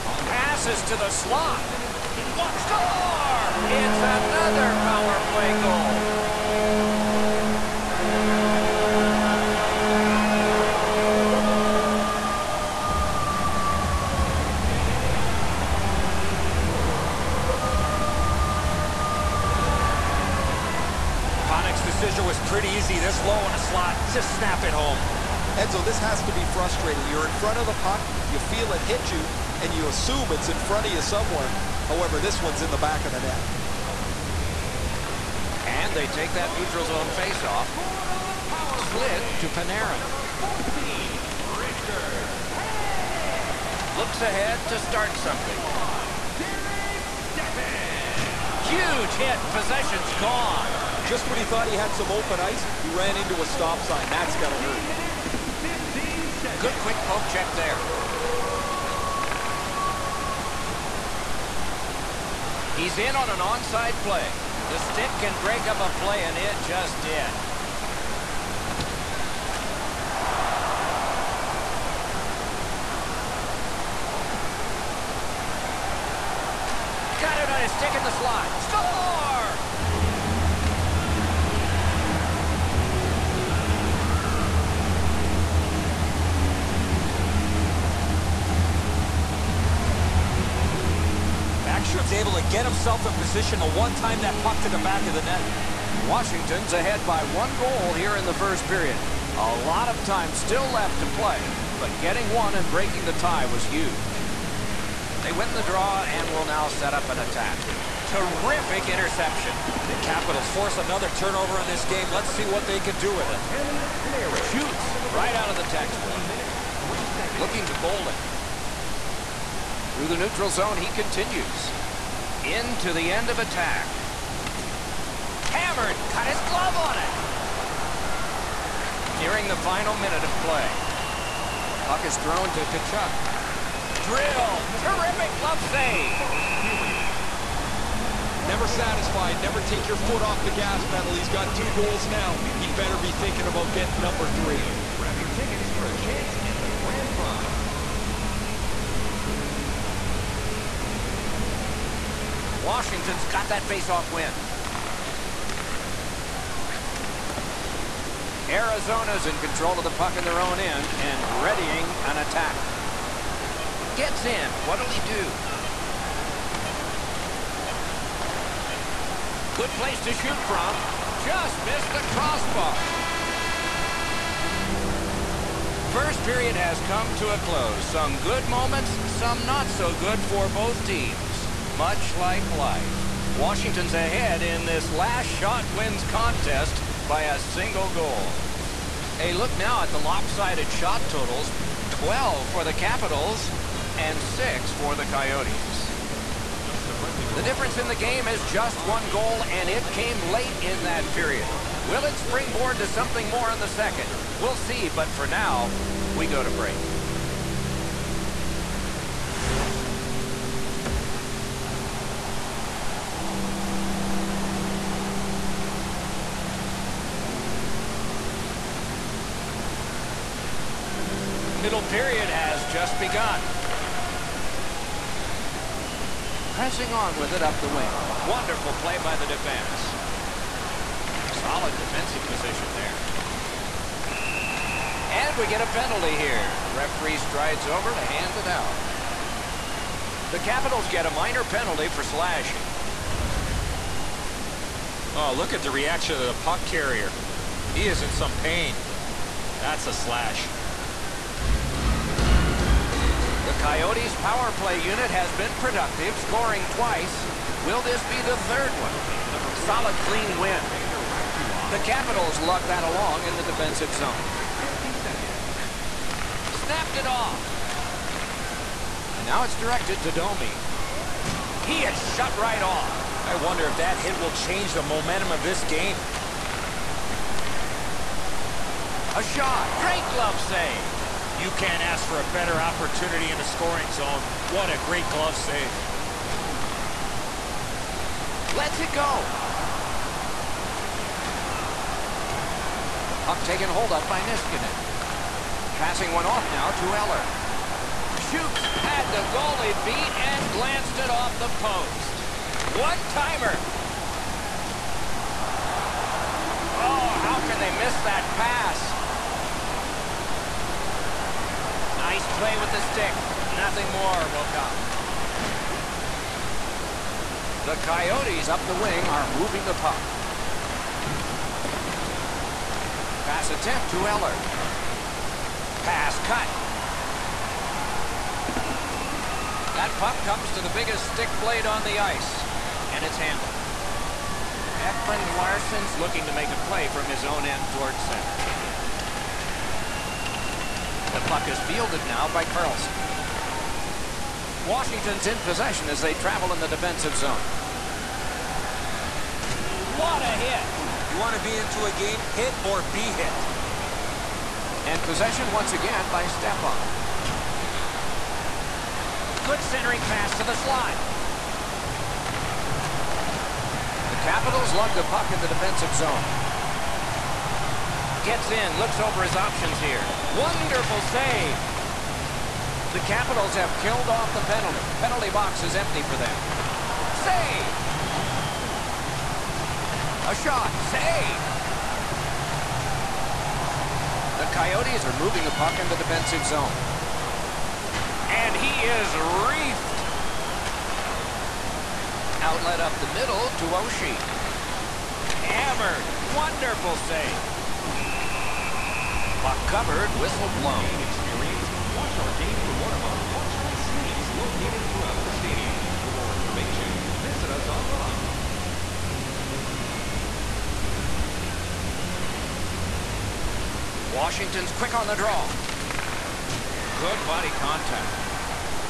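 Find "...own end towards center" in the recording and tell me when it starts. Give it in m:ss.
5:37.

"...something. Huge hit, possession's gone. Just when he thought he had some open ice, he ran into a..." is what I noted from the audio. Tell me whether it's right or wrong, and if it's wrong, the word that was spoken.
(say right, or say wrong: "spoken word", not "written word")
right.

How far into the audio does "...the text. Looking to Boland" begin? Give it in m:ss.
1:55.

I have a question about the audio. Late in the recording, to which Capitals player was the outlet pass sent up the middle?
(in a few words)
Oshie.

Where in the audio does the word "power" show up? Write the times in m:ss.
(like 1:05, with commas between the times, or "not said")
0:04, 4:14.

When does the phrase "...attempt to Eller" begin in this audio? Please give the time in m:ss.
5:23.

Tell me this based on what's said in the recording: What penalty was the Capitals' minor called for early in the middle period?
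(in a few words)
Slashing.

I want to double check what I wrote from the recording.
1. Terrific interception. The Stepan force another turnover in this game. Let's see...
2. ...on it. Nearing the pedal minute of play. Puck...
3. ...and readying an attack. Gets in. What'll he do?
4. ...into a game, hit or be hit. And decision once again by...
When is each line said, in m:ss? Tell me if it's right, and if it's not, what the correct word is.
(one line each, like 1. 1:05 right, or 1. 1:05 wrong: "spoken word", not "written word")
1. 1:48 wrong: "Capitals", not "Stepan"
2. 2:06 wrong: "final", not "pedal"
3. 2:41 right
4. 5:51 wrong: "possession", not "decision".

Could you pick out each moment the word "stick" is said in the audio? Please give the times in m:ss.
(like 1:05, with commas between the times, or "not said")
1:04, 1:17, 5:12, 5:31.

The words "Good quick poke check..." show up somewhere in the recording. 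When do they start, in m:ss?
0:56.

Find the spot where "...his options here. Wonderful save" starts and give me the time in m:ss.
6:09.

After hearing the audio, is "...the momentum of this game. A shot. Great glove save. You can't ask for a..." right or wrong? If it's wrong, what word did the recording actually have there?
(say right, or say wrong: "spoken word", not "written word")
right.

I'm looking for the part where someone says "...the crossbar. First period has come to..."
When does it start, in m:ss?
2:51.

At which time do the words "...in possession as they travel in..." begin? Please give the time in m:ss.
5:45.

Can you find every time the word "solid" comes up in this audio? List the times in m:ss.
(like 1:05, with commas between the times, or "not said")
3:51, 4:19.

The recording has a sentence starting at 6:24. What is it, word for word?
The Coyotes are moving the puck in the defensive zone.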